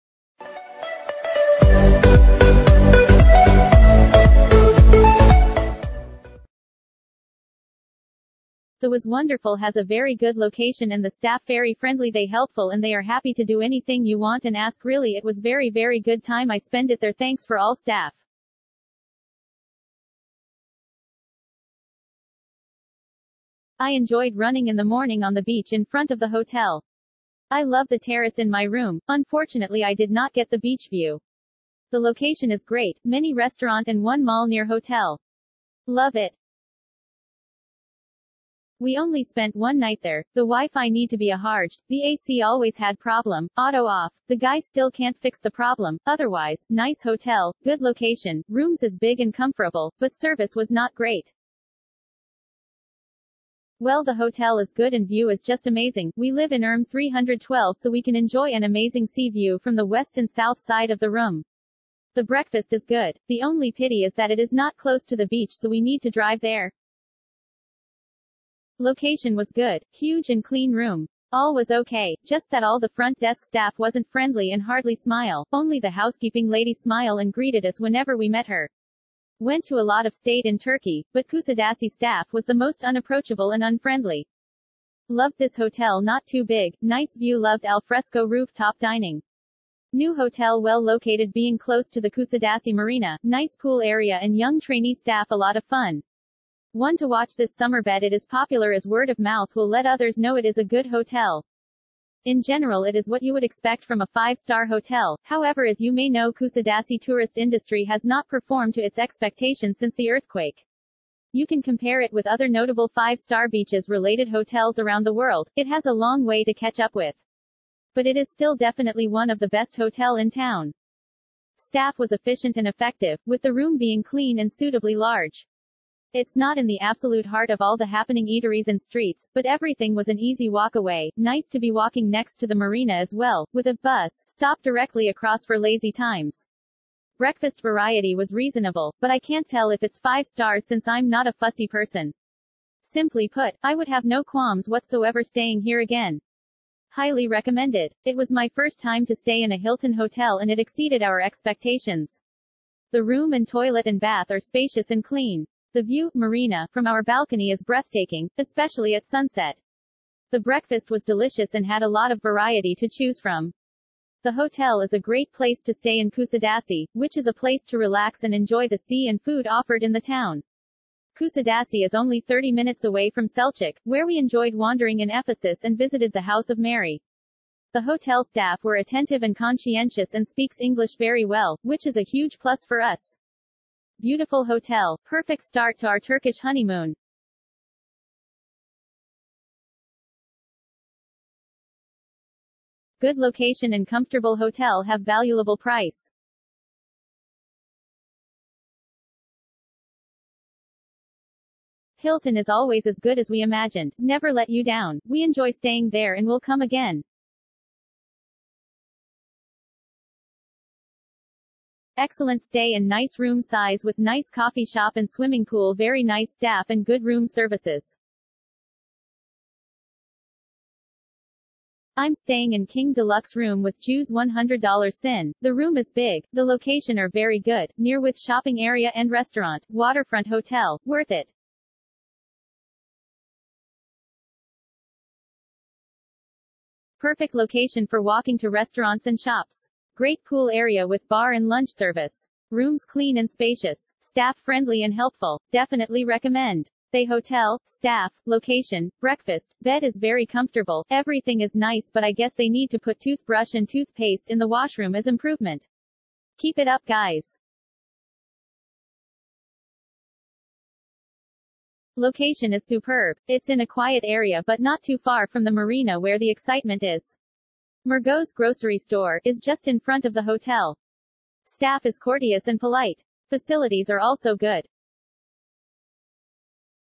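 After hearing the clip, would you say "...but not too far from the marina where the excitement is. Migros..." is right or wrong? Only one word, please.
right.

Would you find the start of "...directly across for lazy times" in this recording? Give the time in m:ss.
2:14.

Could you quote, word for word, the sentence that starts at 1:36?
One to watch this summer bed it is popular as word of mouth will let others know it is a good hotel.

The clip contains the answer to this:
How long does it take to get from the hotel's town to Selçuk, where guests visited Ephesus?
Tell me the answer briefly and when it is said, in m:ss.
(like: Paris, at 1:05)
30 minutes, at 2:52.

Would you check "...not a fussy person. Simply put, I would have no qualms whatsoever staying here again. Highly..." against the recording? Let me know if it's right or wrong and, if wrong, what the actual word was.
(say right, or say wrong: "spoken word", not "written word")
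right.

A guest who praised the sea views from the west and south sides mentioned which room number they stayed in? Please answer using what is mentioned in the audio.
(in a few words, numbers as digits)
312.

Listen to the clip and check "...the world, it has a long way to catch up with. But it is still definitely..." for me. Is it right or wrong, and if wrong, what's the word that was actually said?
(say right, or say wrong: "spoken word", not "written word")
right.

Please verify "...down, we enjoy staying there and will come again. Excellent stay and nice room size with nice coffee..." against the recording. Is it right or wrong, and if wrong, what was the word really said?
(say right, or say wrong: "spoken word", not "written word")
right.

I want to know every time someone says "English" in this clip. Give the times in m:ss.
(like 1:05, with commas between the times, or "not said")
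3:00.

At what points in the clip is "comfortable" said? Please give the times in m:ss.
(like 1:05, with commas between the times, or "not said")
0:49, 3:13, 4:10.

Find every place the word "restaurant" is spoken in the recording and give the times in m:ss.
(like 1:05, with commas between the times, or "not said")
0:33, 3:49, 3:58.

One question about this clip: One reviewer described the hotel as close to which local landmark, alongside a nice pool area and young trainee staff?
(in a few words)
Kusadasi marina.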